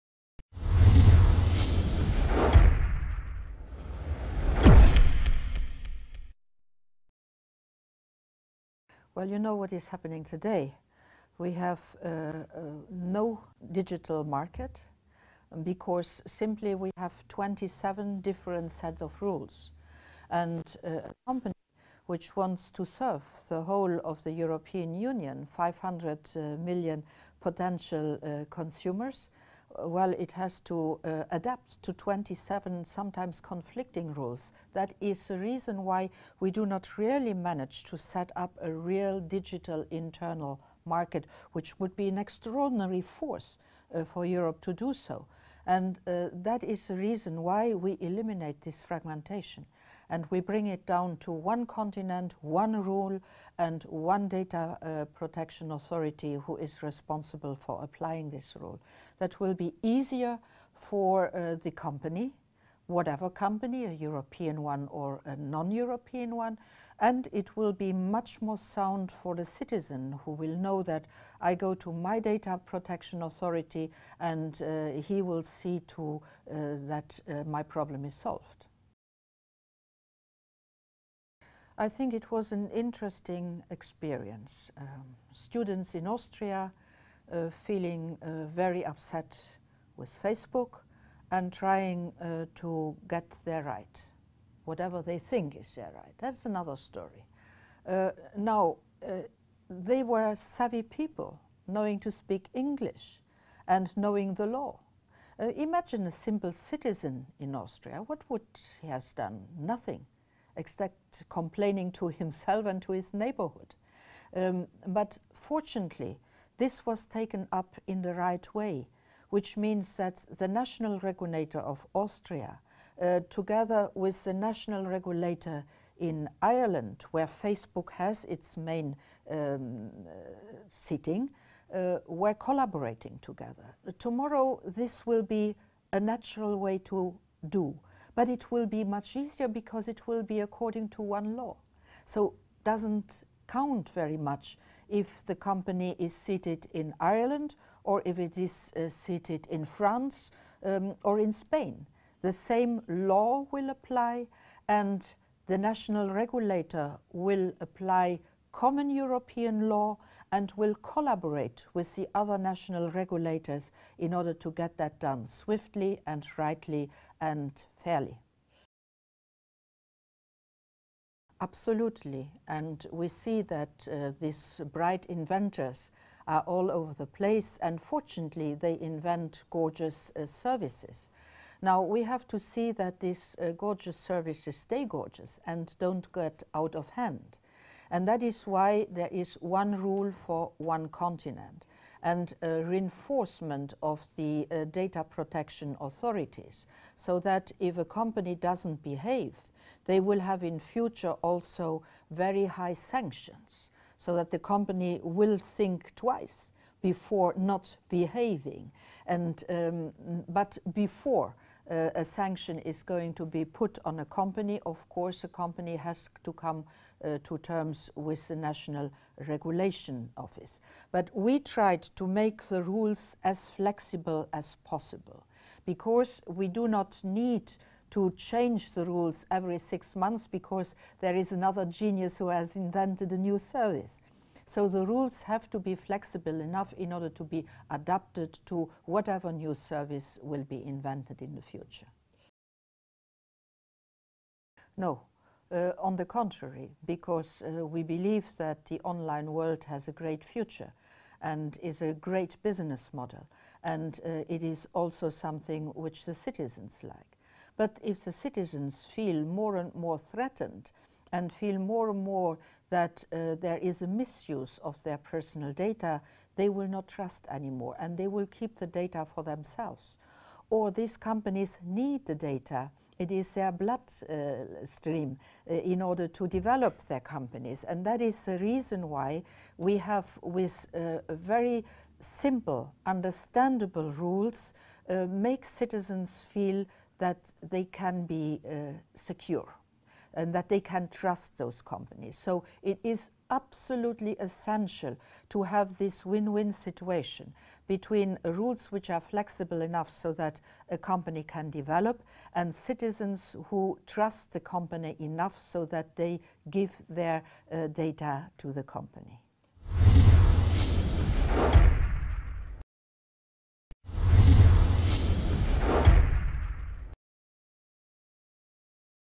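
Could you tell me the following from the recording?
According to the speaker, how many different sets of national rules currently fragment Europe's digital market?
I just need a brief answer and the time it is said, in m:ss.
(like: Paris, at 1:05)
27, at 0:17.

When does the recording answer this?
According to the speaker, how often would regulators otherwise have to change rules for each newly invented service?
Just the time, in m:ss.
3:49.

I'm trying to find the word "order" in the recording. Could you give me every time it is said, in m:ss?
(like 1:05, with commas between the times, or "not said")
2:44, 3:56, 4:35.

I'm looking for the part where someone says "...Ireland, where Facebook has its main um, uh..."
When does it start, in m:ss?
2:06.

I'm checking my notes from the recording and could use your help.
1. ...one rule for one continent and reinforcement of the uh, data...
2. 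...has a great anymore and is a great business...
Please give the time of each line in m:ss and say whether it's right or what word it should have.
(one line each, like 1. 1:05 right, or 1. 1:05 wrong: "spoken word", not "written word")
1. 3:09 right
2. 4:09 wrong: "future", not "anymore".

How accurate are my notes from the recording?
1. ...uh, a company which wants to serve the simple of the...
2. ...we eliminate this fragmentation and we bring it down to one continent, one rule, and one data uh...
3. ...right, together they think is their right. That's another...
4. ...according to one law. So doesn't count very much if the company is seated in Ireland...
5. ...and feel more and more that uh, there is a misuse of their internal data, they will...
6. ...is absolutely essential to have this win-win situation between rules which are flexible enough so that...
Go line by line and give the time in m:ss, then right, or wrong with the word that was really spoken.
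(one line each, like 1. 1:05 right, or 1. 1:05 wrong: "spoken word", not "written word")
1. 0:20 wrong: "whole", not "simple"
2. 0:47 right
3. 1:33 wrong: "whatever", not "together"
4. 2:20 right
5. 4:21 wrong: "personal", not "internal"
6. 4:52 right.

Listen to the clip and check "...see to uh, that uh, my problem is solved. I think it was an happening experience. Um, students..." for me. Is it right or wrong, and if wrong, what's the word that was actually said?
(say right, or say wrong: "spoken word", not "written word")
wrong: "interesting", not "happening".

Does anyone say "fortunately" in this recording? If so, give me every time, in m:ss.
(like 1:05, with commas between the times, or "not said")
1:55, 2:57.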